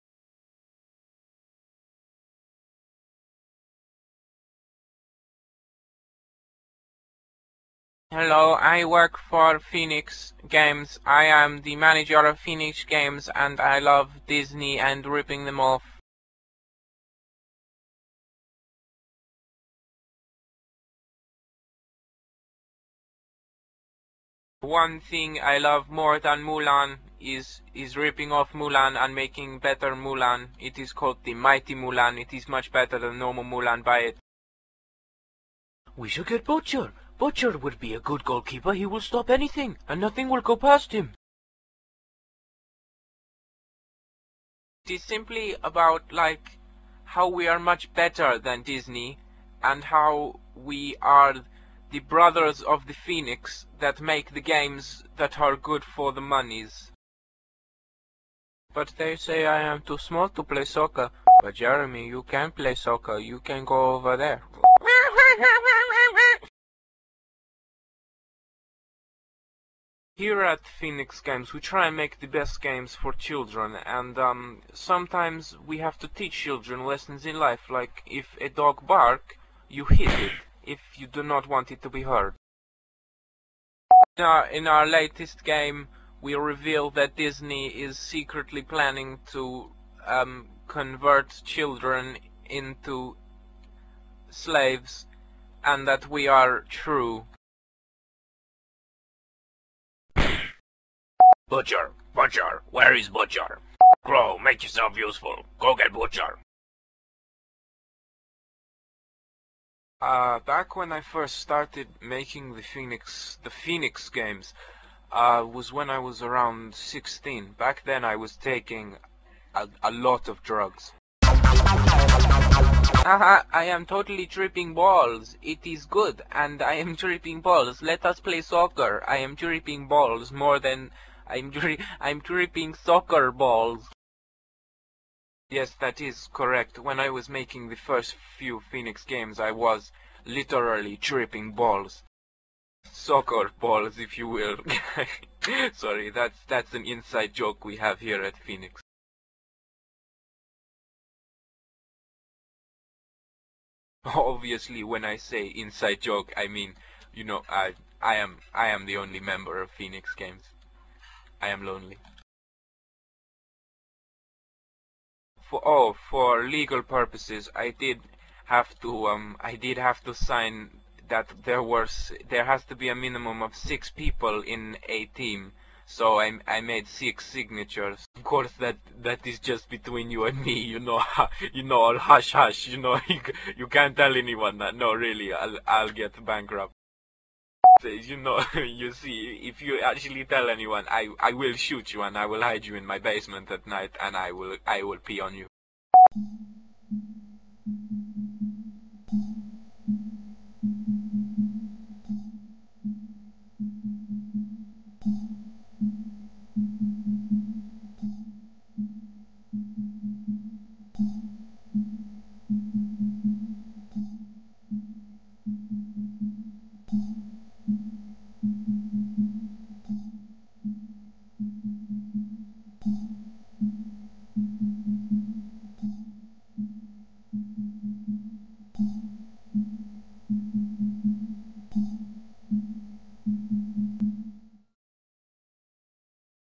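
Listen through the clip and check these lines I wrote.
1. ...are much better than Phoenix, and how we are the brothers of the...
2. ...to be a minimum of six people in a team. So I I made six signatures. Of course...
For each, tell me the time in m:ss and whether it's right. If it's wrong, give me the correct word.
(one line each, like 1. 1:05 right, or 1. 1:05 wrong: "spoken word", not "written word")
1. 0:47 wrong: "Disney", not "Phoenix"
2. 2:52 right.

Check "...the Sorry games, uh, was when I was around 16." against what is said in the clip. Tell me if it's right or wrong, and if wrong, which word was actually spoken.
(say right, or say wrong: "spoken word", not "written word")
wrong: "Phoenix", not "Sorry".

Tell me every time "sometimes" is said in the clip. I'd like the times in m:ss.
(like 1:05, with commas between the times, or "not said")
1:14.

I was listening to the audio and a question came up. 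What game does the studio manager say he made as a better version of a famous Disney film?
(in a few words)
Mighty Mulan.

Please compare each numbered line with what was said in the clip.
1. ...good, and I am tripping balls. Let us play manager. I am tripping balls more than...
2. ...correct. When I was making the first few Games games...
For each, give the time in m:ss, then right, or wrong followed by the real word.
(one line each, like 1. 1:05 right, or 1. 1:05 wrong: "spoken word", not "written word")
1. 2:05 wrong: "soccer", not "manager"
2. 2:16 wrong: "Phoenix", not "Games".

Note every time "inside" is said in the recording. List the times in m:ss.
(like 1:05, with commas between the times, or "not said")
2:26, 2:35.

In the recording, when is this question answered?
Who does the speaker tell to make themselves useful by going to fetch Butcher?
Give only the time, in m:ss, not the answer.
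1:44.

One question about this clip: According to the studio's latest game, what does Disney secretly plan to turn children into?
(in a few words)
slaves.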